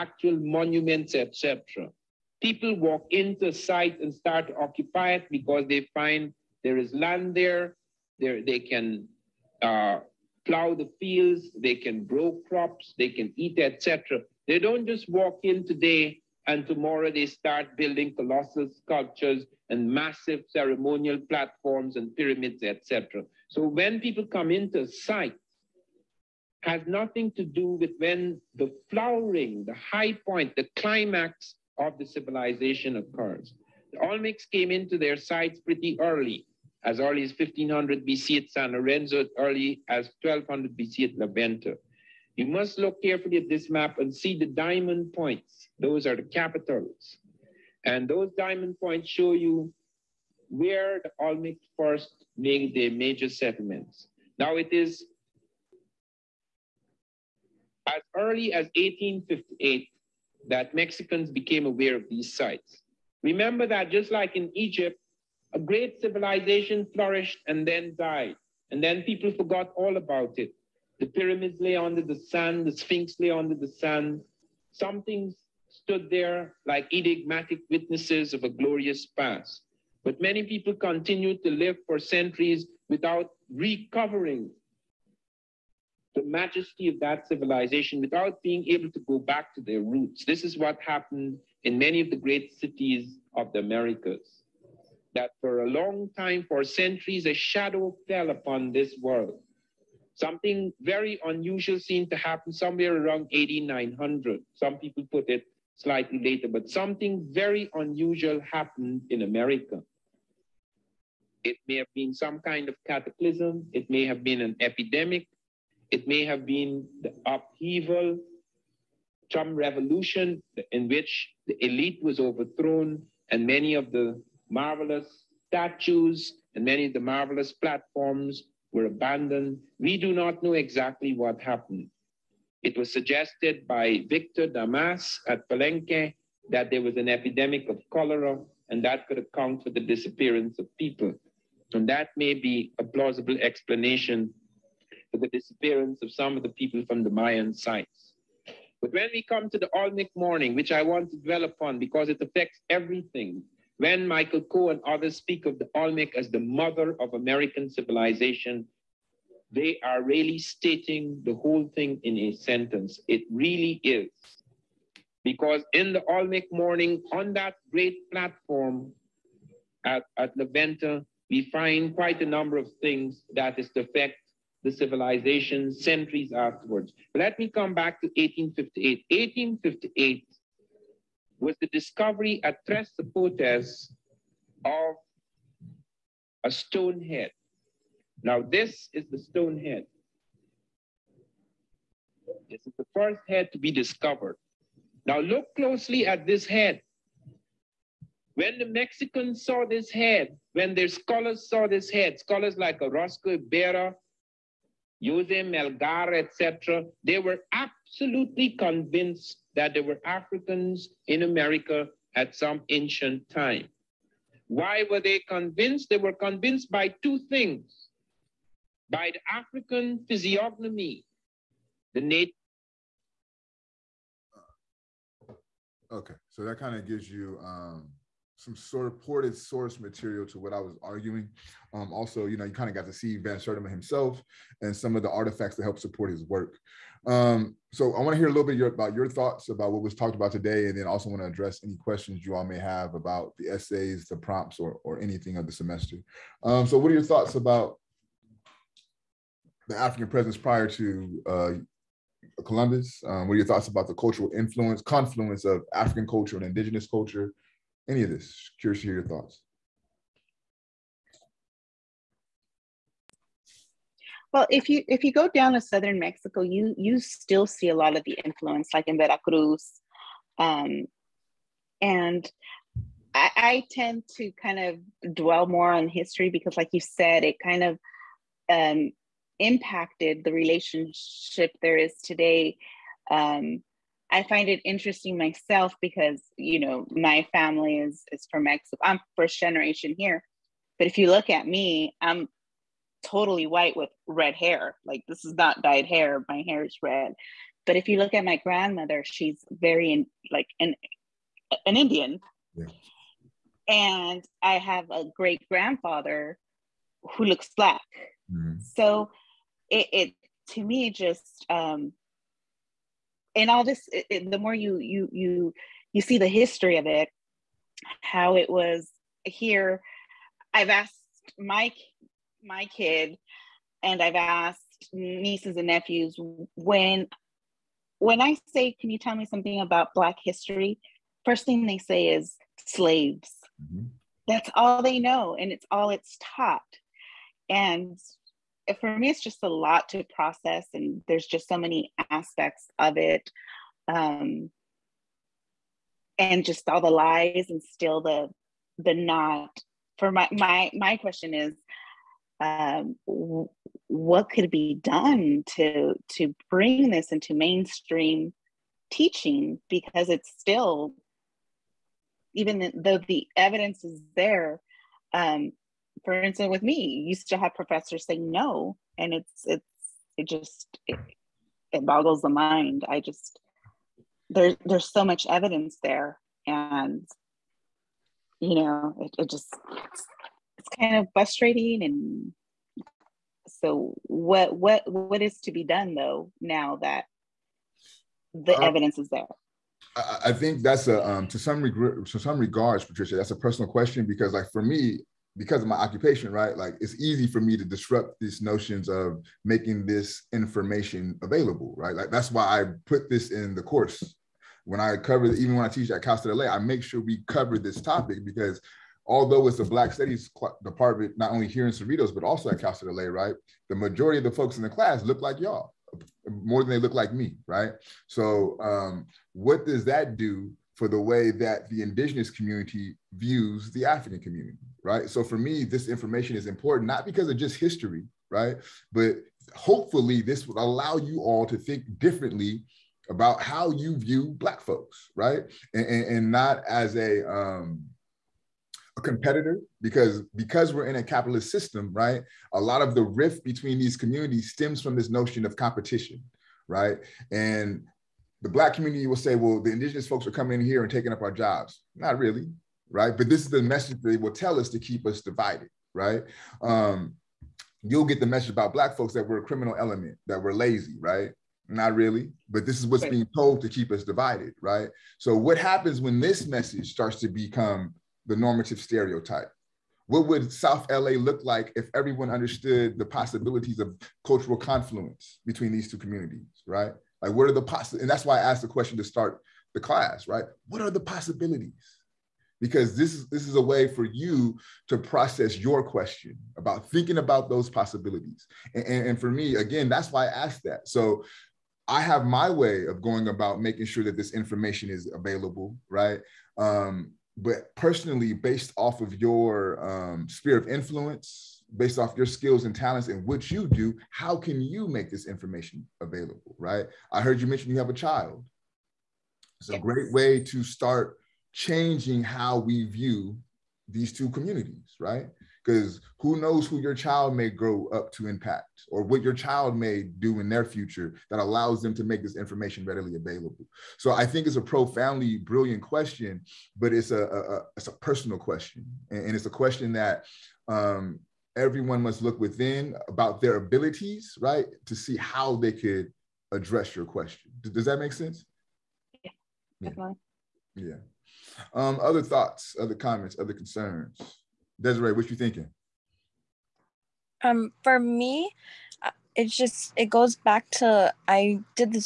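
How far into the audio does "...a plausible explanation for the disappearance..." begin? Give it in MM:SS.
02:22.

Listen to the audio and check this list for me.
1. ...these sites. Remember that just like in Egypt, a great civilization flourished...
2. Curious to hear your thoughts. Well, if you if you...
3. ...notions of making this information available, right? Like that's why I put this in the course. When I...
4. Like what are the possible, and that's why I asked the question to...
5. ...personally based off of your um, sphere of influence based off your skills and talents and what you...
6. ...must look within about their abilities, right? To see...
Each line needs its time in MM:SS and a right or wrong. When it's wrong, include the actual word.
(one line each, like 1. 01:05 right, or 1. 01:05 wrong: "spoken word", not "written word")
1. 01:02 right
2. 04:18 right
3. 06:38 right
4. 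07:57 right
5. 08:17 right
6. 08:52 right.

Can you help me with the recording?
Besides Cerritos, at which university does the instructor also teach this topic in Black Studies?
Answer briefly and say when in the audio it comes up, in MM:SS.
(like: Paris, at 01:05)
Cal State LA, at 06:52.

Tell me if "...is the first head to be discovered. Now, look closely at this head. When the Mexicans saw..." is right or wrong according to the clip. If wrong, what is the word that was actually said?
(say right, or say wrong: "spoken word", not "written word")
right.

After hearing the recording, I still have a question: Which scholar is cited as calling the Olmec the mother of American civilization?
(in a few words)
Michael Coe.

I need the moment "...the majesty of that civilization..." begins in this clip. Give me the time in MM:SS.
01:26.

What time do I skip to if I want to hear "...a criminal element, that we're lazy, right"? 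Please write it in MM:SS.
07:39.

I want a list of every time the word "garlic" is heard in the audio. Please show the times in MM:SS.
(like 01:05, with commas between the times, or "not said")
not said.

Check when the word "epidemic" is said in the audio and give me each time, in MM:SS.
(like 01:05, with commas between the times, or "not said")
01:54, 02:17.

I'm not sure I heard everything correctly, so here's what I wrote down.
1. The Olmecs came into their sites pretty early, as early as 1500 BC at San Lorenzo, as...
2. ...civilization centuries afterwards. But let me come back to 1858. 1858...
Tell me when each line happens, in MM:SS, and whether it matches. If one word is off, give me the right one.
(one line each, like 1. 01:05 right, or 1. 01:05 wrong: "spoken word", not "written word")
1. 00:33 right
2. 02:54 right.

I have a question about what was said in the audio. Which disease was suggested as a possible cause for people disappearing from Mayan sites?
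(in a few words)
cholera.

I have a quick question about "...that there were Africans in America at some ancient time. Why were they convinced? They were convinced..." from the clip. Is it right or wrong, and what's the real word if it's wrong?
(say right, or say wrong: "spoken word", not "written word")
right.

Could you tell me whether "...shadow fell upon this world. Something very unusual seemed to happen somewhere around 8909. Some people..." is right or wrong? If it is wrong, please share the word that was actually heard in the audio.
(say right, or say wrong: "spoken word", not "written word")
wrong: "8900", not "8909".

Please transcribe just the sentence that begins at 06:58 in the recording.
So um, what does that do for the way that the indigenous community views the African community, right?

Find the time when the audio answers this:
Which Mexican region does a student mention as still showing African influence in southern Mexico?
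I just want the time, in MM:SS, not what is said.
04:28.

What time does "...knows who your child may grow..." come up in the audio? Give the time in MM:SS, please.
08:36.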